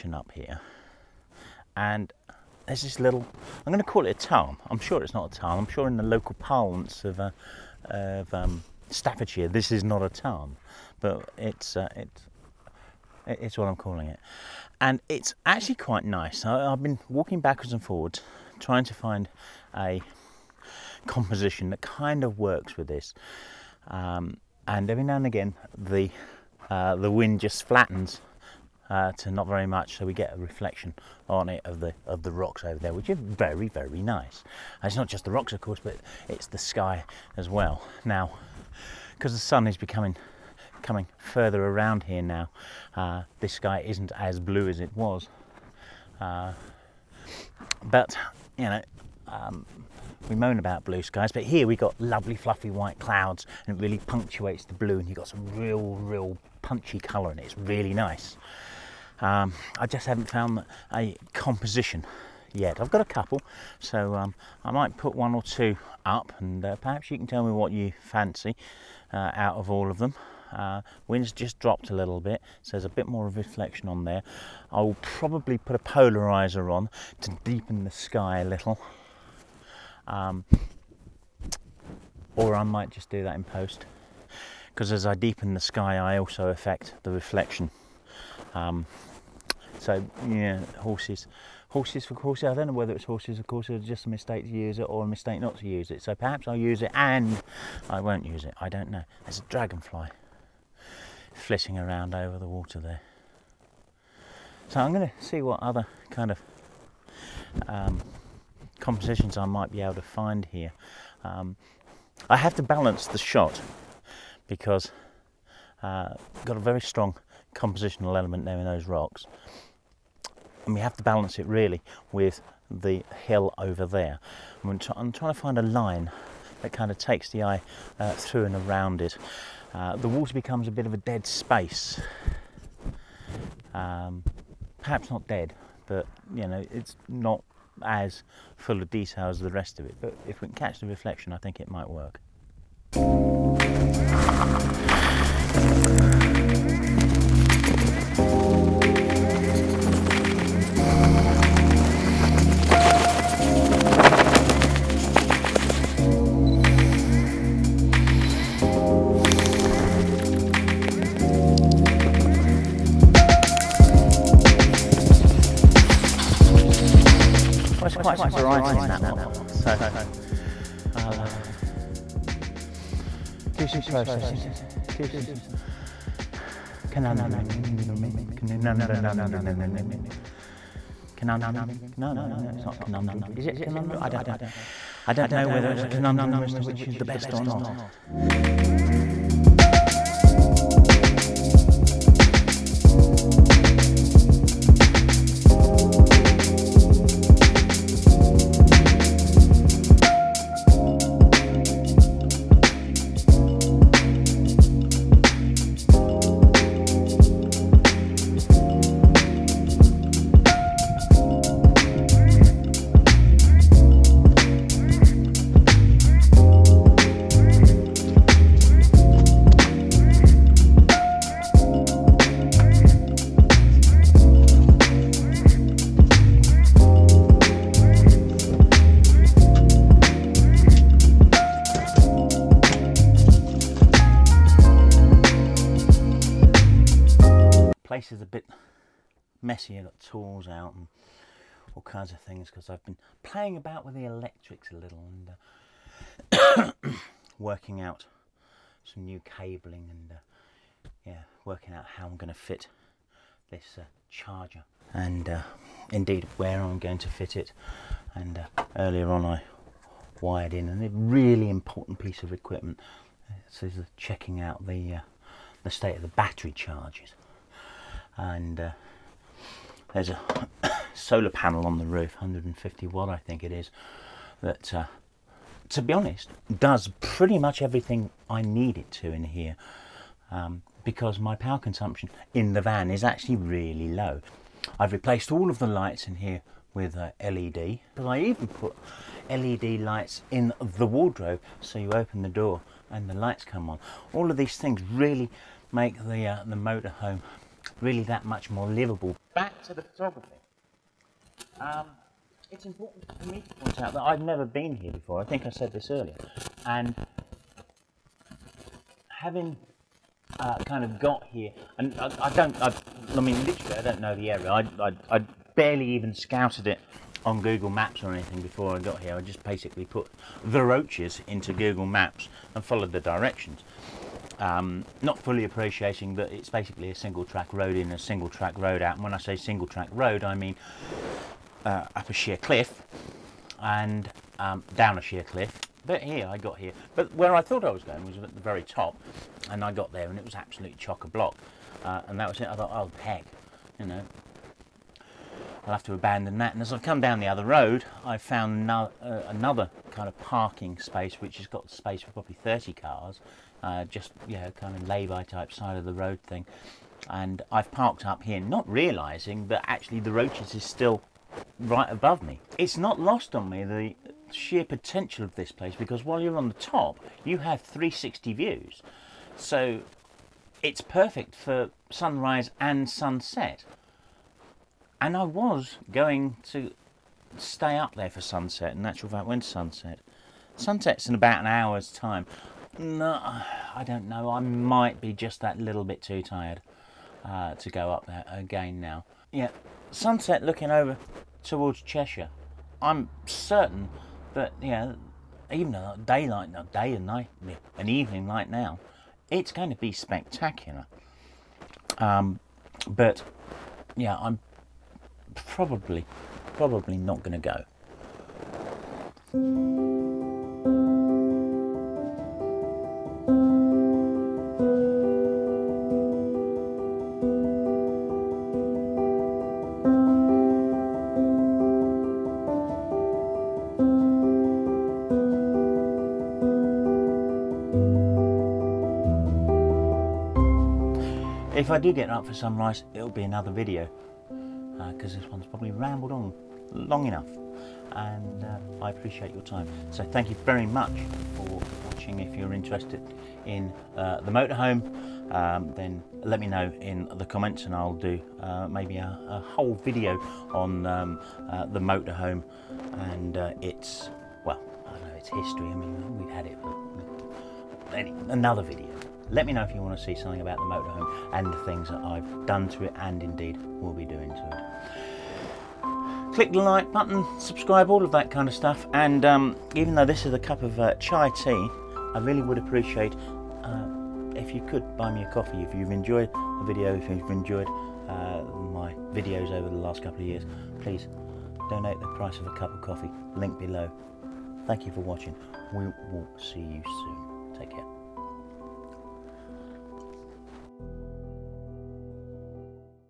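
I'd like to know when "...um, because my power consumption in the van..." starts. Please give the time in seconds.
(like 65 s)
280 s.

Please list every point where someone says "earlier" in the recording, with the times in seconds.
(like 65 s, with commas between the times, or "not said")
258 s, 305 s.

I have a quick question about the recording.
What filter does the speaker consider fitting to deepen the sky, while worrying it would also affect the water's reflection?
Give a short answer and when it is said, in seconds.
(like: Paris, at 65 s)
Polarizer, at 75 s.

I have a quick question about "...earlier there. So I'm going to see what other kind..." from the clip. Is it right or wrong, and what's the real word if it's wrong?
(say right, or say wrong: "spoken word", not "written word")
wrong: "water", not "earlier".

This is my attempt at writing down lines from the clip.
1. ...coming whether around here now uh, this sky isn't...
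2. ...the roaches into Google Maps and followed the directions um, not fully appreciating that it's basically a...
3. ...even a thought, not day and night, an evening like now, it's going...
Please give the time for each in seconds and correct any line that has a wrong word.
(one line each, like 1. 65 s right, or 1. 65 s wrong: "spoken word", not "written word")
1. 40 s wrong: "further", not "whether"
2. 320 s right
3. 395 s wrong: "daylight", not "thought".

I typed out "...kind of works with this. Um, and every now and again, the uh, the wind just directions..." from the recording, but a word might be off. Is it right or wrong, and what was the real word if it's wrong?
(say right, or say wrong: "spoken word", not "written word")
wrong: "flattens", not "directions".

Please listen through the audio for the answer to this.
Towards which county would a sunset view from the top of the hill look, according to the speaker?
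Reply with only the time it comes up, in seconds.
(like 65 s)
391 s.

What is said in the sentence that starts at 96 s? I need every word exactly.
So perhaps I'll use it and I won't use it.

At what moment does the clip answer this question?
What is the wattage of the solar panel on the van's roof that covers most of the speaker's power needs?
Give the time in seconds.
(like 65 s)
272 s.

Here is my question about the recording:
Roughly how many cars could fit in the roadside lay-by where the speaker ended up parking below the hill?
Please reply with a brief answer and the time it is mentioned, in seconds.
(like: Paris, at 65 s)
30, at 352 s.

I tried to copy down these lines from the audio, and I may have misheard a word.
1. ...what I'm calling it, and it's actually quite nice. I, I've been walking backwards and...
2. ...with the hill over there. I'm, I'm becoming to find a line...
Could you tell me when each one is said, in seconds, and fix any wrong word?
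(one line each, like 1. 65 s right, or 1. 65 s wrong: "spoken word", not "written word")
1. 13 s right
2. 122 s wrong: "trying", not "becoming".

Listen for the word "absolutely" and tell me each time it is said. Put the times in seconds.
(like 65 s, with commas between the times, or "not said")
340 s.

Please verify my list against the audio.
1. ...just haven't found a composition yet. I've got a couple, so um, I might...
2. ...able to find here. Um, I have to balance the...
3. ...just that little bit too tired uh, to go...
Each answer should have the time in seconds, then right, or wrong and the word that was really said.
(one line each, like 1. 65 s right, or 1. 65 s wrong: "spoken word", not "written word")
1. 59 s right
2. 109 s right
3. 385 s right.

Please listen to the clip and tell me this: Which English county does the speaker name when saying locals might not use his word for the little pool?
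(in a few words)
Staffordshire.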